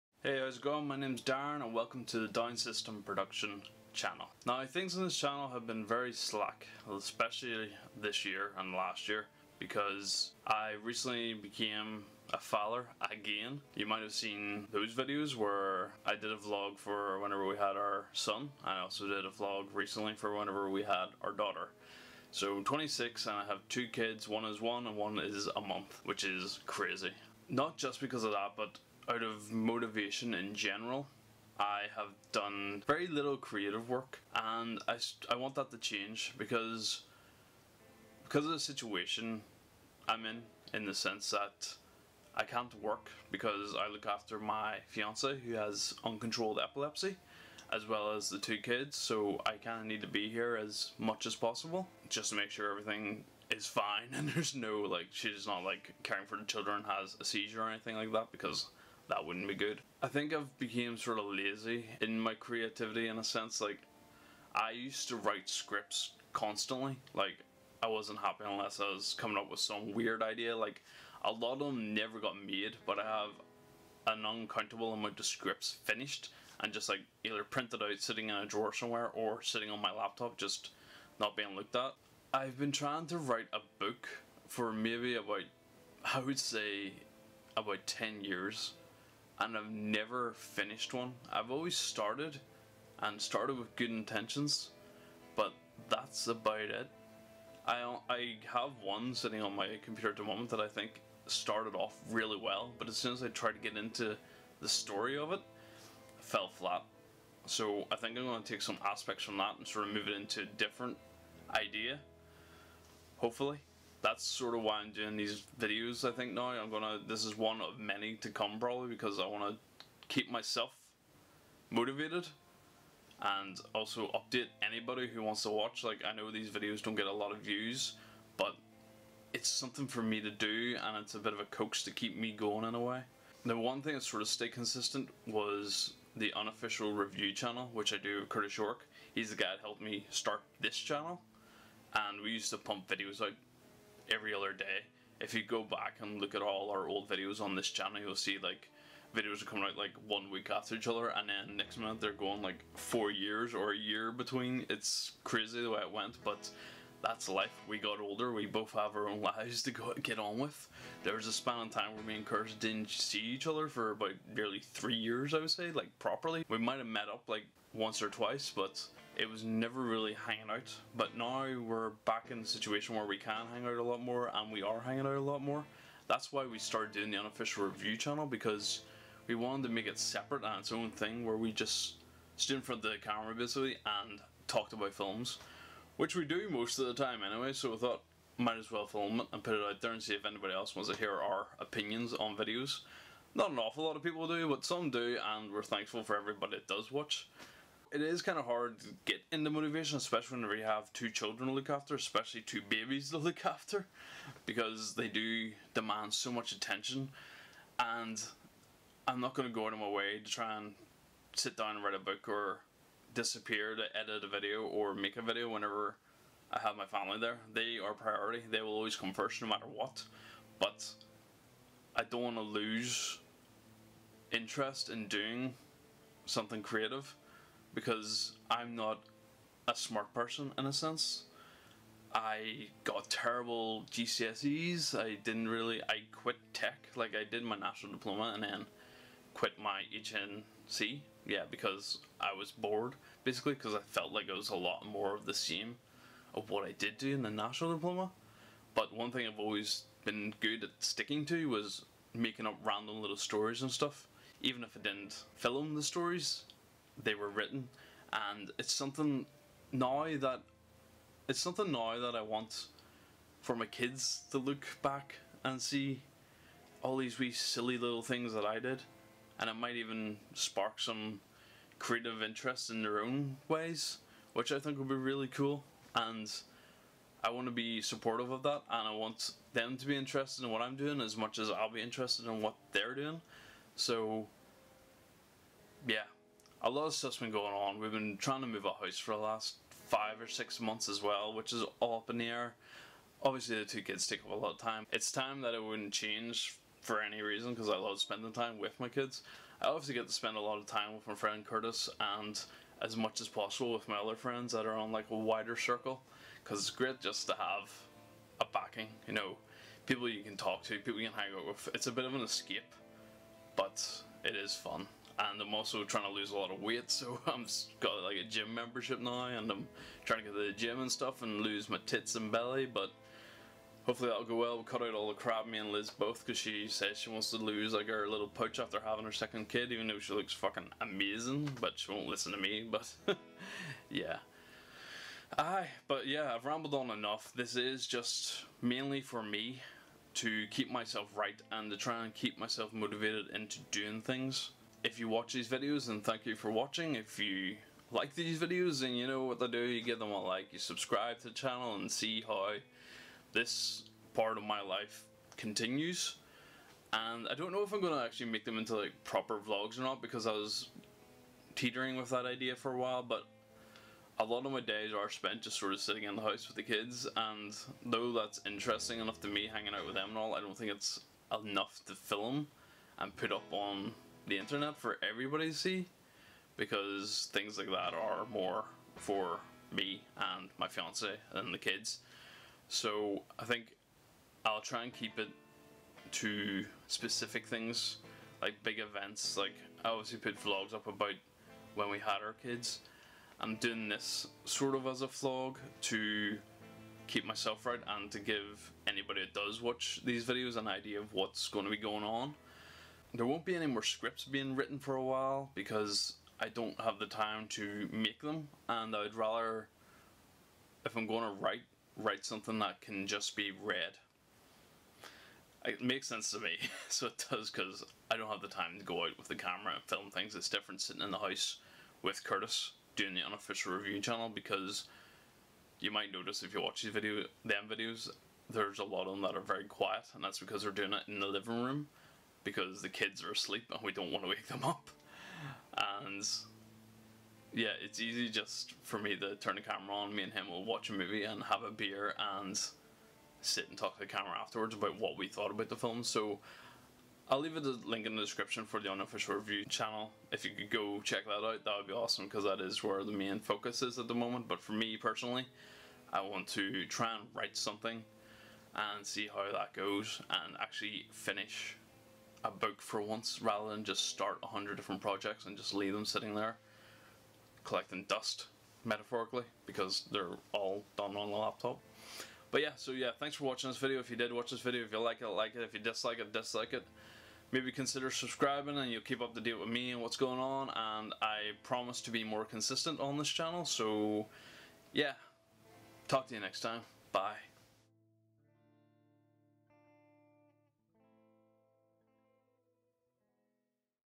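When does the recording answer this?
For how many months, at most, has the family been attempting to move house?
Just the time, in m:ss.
4:50.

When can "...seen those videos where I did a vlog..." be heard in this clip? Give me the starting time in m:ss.
0:14.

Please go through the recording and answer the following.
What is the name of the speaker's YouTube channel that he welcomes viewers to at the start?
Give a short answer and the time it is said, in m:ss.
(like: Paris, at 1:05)
Down System Production, at 0:02.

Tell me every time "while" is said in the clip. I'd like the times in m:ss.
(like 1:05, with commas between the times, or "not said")
6:02, 6:45.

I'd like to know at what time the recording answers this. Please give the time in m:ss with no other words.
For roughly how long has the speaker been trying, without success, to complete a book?
1:27.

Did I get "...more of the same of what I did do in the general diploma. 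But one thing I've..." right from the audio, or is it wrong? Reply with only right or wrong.
wrong.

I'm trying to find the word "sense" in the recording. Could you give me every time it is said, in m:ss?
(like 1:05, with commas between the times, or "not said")
0:40, 1:03, 3:50, 6:56.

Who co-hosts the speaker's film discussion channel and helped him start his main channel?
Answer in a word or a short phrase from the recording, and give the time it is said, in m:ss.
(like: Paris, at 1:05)
Curtis York, at 2:18.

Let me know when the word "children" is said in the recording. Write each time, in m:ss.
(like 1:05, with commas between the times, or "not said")
0:56, 3:21.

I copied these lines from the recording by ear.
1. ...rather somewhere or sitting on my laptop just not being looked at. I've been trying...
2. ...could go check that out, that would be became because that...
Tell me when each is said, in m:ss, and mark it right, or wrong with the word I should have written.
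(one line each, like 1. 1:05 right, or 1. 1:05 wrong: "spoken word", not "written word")
1. 1:18 wrong: "drawer", not "rather"
2. 7:30 wrong: "awesome", not "became".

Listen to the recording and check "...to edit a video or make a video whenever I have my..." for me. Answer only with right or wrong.
right.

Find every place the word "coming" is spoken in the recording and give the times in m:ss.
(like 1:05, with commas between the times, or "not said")
1:09, 2:29.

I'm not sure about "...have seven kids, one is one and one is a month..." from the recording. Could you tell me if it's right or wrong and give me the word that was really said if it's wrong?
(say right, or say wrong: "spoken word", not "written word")
wrong: "two", not "seven".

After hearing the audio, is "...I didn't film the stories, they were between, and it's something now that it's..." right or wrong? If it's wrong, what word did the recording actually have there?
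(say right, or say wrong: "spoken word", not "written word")
wrong: "written", not "between".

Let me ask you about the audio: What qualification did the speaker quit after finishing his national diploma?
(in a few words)
HNC.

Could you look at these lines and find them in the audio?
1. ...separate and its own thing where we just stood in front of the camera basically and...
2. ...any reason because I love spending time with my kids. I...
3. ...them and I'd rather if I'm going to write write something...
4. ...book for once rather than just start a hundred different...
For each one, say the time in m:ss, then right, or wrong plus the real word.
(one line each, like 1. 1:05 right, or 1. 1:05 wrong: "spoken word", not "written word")
1. 2:59 right
2. 4:57 right
3. 6:48 right
4. 7:42 right.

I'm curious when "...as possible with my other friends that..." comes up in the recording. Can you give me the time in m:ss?
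5:03.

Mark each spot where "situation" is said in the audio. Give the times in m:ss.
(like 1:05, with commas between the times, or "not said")
0:38, 2:52.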